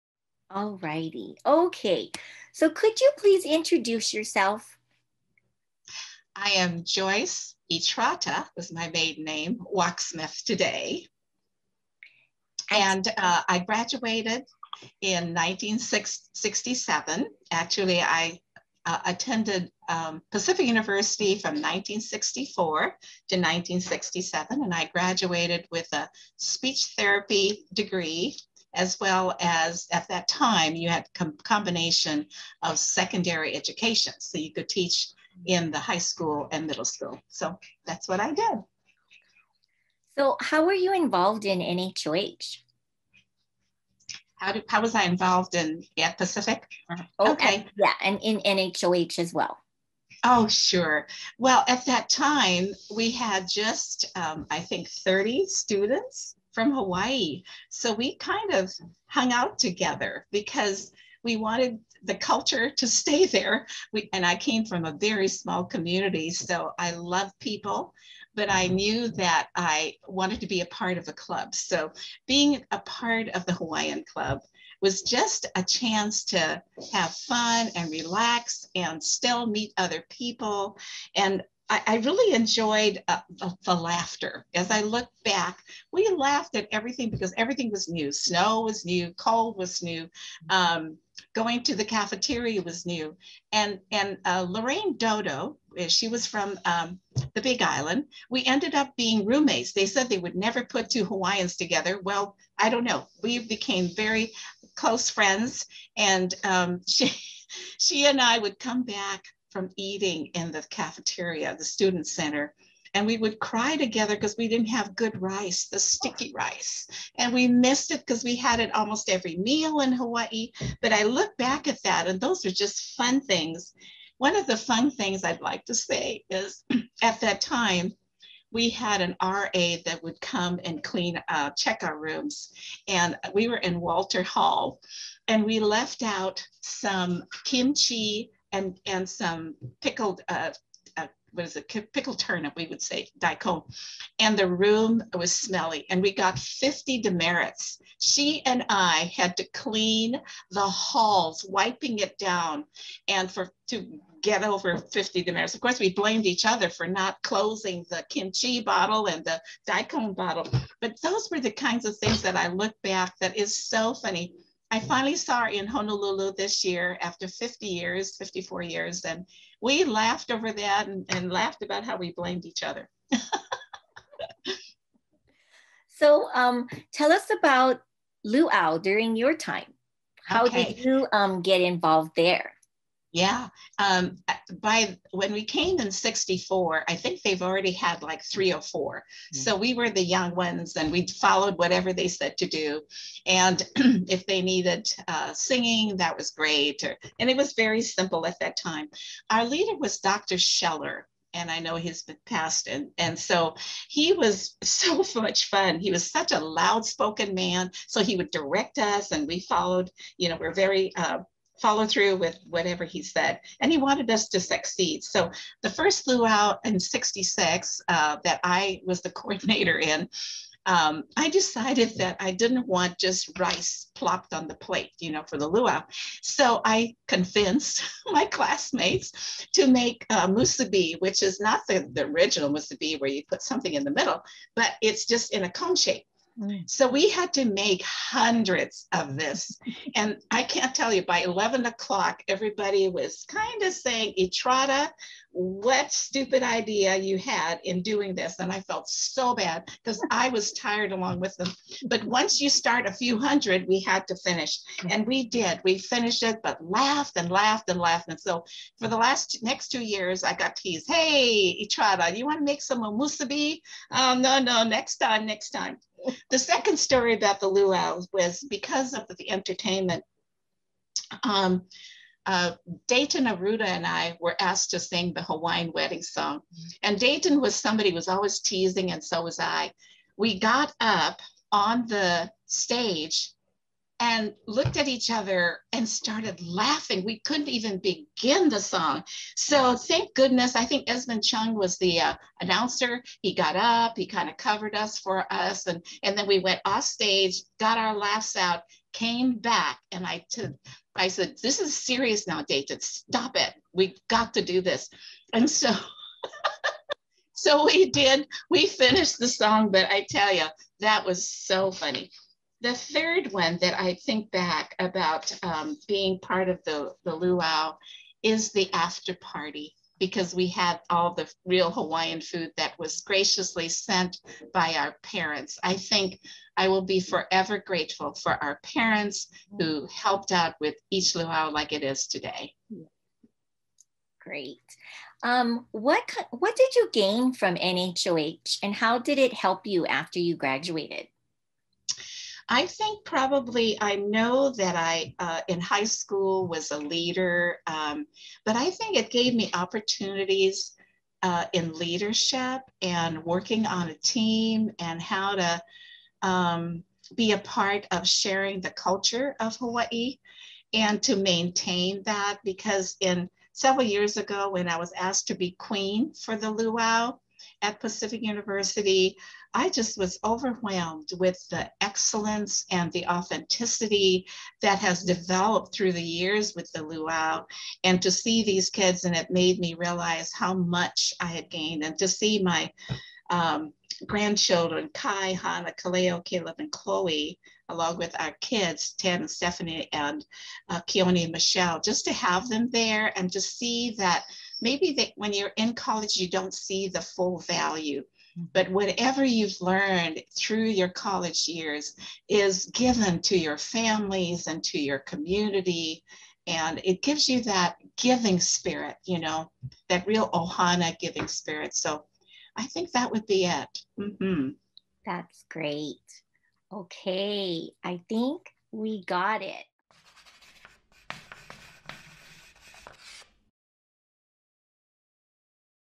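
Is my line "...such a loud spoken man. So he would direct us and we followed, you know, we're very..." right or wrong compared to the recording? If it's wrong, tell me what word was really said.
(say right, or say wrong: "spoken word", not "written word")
right.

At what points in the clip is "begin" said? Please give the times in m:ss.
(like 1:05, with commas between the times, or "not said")
4:47.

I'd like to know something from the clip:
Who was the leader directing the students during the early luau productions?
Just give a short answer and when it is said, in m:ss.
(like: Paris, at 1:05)
Dr. Scheller, at 3:19.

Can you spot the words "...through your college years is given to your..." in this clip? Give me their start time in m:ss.
6:40.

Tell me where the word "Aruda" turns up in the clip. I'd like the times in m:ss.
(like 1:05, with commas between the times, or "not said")
4:33.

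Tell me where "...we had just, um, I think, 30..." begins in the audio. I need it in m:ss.
0:52.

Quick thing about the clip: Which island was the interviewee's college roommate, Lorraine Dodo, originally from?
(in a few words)
Big Island.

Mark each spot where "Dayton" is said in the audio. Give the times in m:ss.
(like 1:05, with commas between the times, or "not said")
4:32, 4:36.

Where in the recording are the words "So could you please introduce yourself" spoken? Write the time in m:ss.
0:02.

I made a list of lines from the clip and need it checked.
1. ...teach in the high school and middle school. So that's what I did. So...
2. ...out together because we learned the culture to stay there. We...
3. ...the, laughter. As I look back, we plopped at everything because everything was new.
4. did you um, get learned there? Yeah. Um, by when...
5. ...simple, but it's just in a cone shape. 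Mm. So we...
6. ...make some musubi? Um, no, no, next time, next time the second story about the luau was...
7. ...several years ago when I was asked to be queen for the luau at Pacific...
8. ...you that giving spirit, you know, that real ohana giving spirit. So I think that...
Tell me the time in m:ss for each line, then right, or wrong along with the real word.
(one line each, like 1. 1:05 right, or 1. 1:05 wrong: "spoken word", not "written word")
1. 0:34 right
2. 0:59 wrong: "wanted", not "learned"
3. 1:23 wrong: "laughed", not "plopped"
4. 3:00 wrong: "involved", not "learned"
5. 3:53 wrong: "middle", not "simple"
6. 4:22 right
7. 6:03 right
8. 6:47 right.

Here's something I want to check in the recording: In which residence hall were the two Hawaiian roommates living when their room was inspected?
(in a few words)
Walter Hall.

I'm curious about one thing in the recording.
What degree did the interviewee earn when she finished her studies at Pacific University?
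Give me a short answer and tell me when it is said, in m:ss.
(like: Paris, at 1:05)
Speech therapy, at 0:26.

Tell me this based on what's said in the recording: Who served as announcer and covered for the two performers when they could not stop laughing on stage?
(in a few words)
Esmond Chung.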